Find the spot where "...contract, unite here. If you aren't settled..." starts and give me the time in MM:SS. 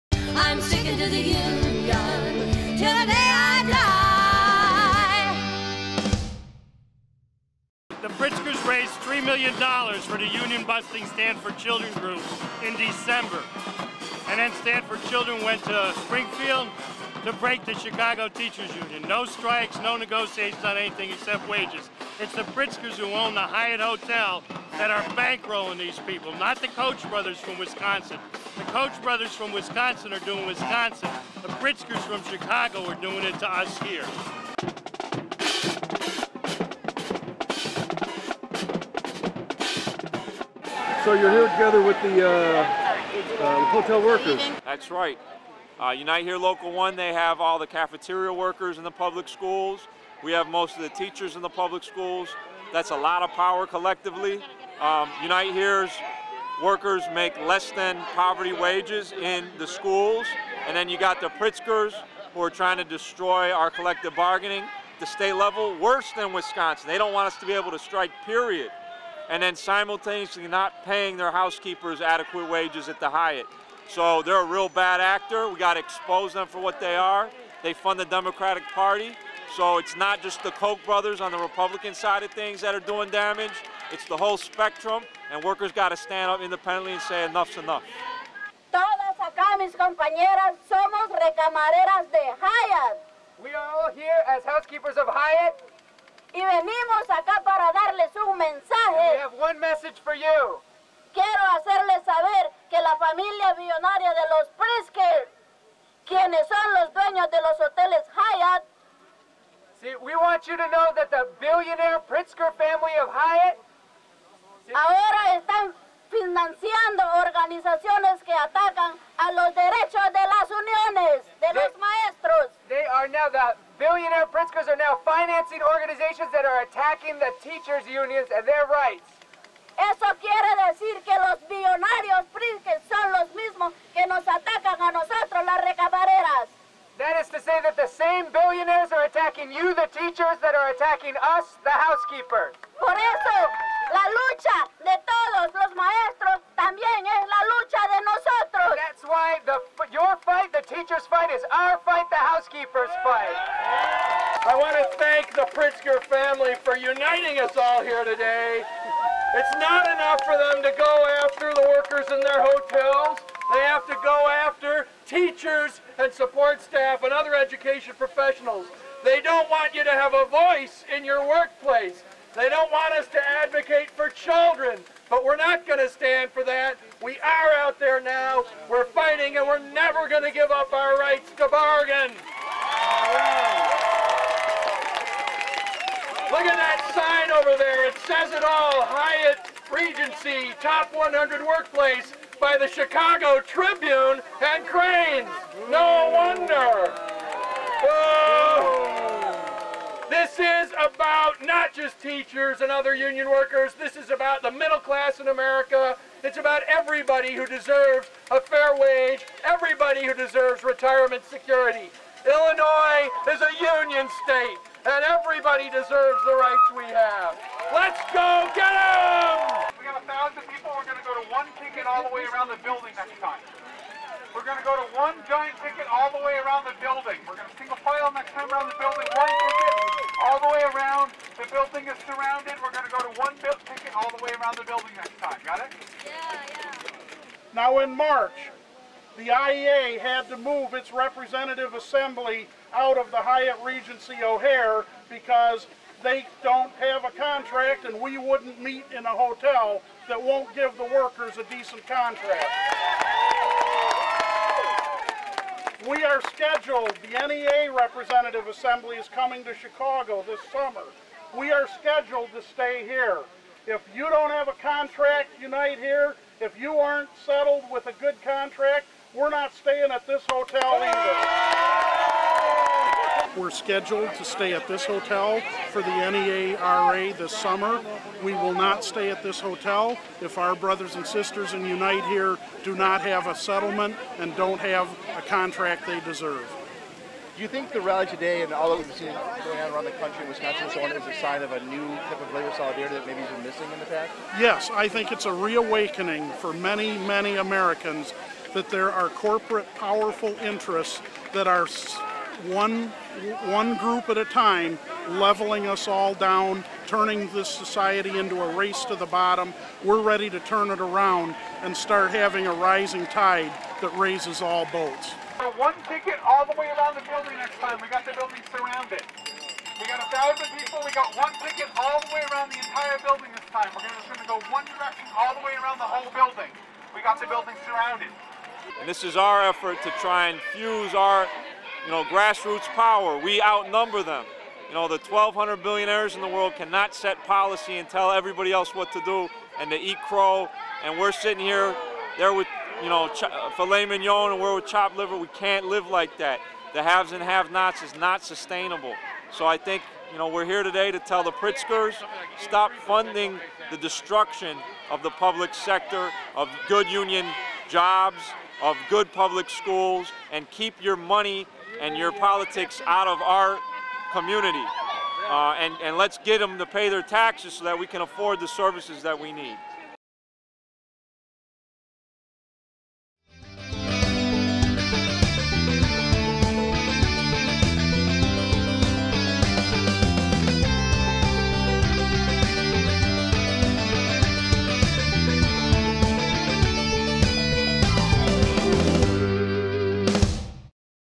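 04:24.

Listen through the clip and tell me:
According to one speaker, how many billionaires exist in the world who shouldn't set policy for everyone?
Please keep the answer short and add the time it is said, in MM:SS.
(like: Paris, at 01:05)
1,200, at 05:34.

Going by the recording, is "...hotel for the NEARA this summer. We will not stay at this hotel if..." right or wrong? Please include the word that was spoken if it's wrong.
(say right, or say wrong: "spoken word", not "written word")
right.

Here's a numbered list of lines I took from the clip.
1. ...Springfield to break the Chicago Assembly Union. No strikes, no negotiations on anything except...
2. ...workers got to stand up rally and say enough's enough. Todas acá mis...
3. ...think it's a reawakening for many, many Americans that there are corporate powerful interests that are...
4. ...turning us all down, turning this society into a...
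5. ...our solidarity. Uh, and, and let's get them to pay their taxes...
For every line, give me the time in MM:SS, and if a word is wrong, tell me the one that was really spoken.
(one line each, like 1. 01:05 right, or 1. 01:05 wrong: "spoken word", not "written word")
1. 00:16 wrong: "Teachers", not "Assembly"
2. 01:25 wrong: "independently", not "rally"
3. 04:54 right
4. 05:05 wrong: "leveling", not "turning"
5. 06:03 wrong: "community", not "solidarity".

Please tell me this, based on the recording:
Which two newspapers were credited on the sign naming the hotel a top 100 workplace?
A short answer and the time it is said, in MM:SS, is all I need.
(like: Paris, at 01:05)
Chicago Tribune and Crain's, at 03:12.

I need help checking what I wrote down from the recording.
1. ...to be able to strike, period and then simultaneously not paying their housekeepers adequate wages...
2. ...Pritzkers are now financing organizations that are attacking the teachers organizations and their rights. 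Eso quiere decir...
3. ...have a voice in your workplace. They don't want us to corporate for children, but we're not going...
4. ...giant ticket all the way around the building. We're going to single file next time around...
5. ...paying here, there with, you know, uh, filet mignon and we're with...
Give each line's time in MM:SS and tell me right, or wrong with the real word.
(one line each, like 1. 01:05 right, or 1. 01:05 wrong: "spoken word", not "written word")
1. 01:07 right
2. 02:04 wrong: "unions", not "organizations"
3. 02:49 wrong: "advocate", not "corporate"
4. 03:45 right
5. 05:41 wrong: "sitting", not "paying".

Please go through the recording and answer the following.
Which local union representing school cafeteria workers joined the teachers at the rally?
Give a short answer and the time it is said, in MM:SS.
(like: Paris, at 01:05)
Unite Here Local 1, at 00:45.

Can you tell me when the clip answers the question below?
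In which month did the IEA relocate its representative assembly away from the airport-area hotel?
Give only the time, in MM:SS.
03:57.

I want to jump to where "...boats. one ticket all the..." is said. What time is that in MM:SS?
05:14.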